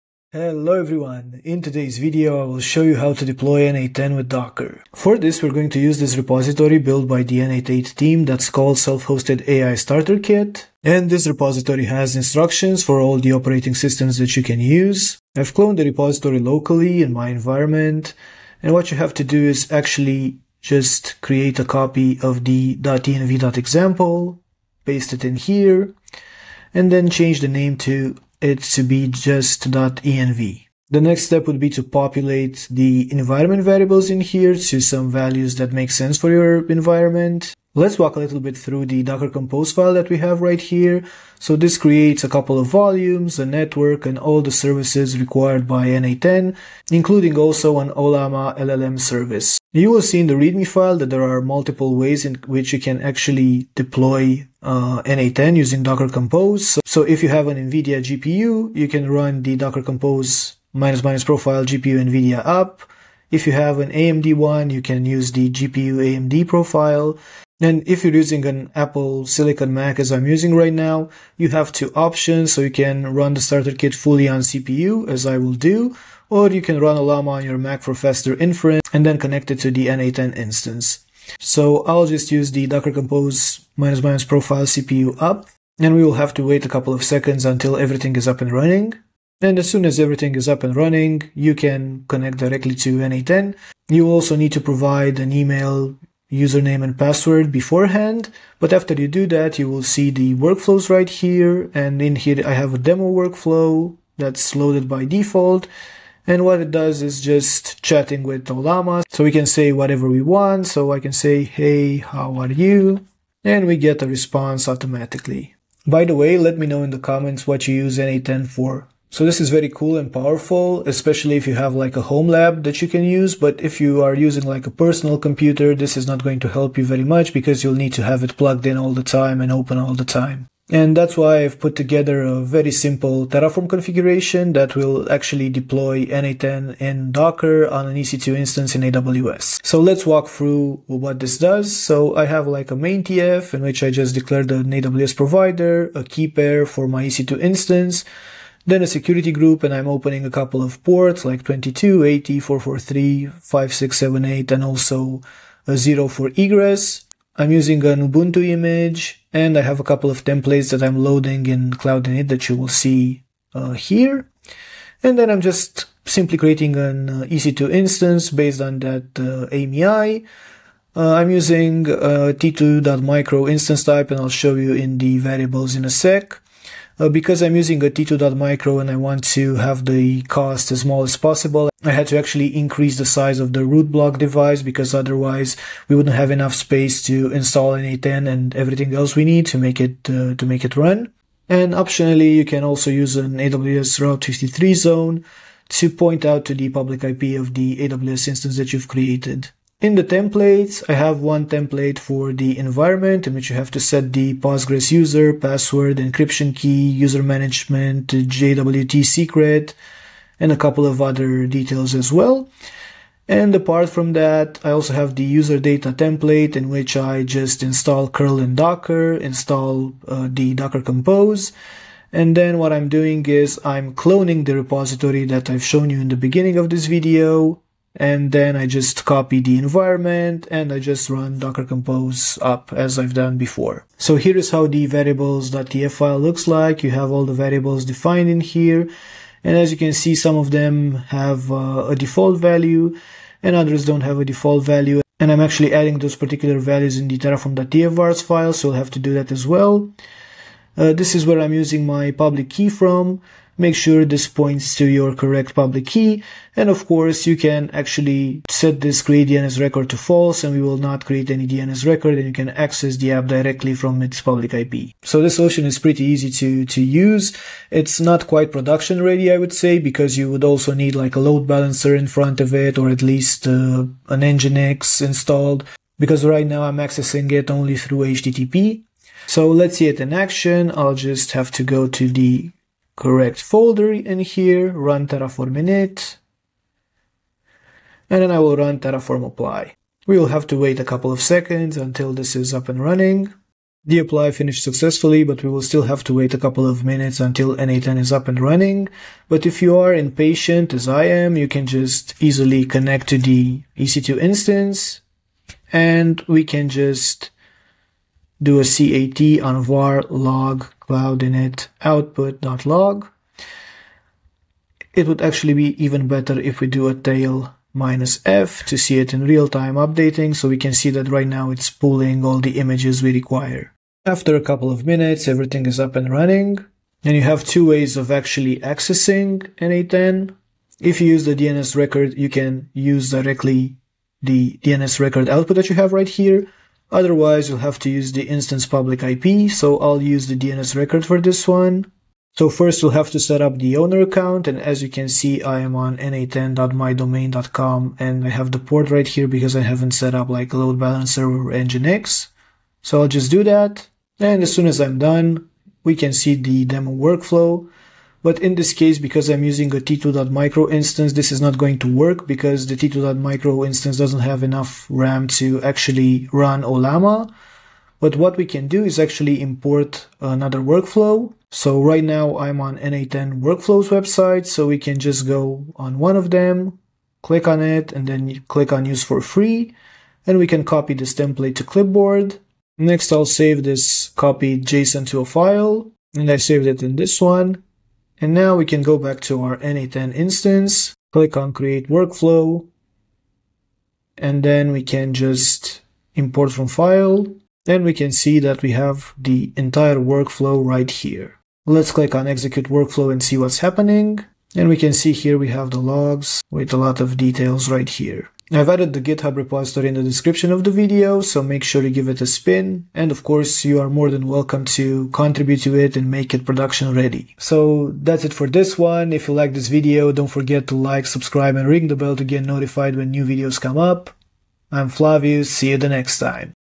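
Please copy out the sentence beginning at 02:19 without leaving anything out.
So let's walk through what this does.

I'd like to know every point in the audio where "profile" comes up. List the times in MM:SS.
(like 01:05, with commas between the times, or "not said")
01:01, 01:06, 01:24.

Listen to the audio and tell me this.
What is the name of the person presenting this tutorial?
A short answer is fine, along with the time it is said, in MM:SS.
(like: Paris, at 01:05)
Flavius, at 07:04.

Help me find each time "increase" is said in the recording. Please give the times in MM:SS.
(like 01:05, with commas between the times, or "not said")
03:02.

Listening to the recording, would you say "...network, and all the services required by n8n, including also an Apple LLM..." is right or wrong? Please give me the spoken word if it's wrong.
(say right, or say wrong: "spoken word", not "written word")
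wrong: "Ollama", not "Apple".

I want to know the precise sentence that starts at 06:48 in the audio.
I've added the GitHub repository in the description of the video, so make sure to give it a spin.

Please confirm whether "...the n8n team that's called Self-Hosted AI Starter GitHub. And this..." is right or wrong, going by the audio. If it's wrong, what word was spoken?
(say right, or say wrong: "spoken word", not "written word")
wrong: "Kit", not "GitHub".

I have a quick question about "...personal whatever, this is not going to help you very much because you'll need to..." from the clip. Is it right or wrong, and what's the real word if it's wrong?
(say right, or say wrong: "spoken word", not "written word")
wrong: "computer", not "whatever".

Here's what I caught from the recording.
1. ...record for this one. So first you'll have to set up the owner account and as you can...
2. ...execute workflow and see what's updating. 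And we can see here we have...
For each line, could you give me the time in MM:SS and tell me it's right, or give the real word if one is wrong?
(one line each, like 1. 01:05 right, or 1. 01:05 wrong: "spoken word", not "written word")
1. 05:40 right
2. 06:42 wrong: "happening", not "updating".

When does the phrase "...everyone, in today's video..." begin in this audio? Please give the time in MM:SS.
00:00.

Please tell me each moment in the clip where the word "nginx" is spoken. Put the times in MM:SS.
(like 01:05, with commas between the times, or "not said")
04:34, 05:51.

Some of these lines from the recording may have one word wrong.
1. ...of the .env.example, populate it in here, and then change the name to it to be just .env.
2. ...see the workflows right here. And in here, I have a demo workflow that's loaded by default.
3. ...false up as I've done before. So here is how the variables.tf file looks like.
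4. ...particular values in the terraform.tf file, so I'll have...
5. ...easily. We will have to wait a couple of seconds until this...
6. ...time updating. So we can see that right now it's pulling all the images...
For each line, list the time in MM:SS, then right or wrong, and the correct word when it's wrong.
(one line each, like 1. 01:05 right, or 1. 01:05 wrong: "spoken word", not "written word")
1. 00:22 wrong: "paste", not "populate"
2. 01:39 right
3. 03:51 wrong: "compose", not "false"
4. 04:06 right
5. 04:49 wrong: "apply", not "easily"
6. 05:19 right.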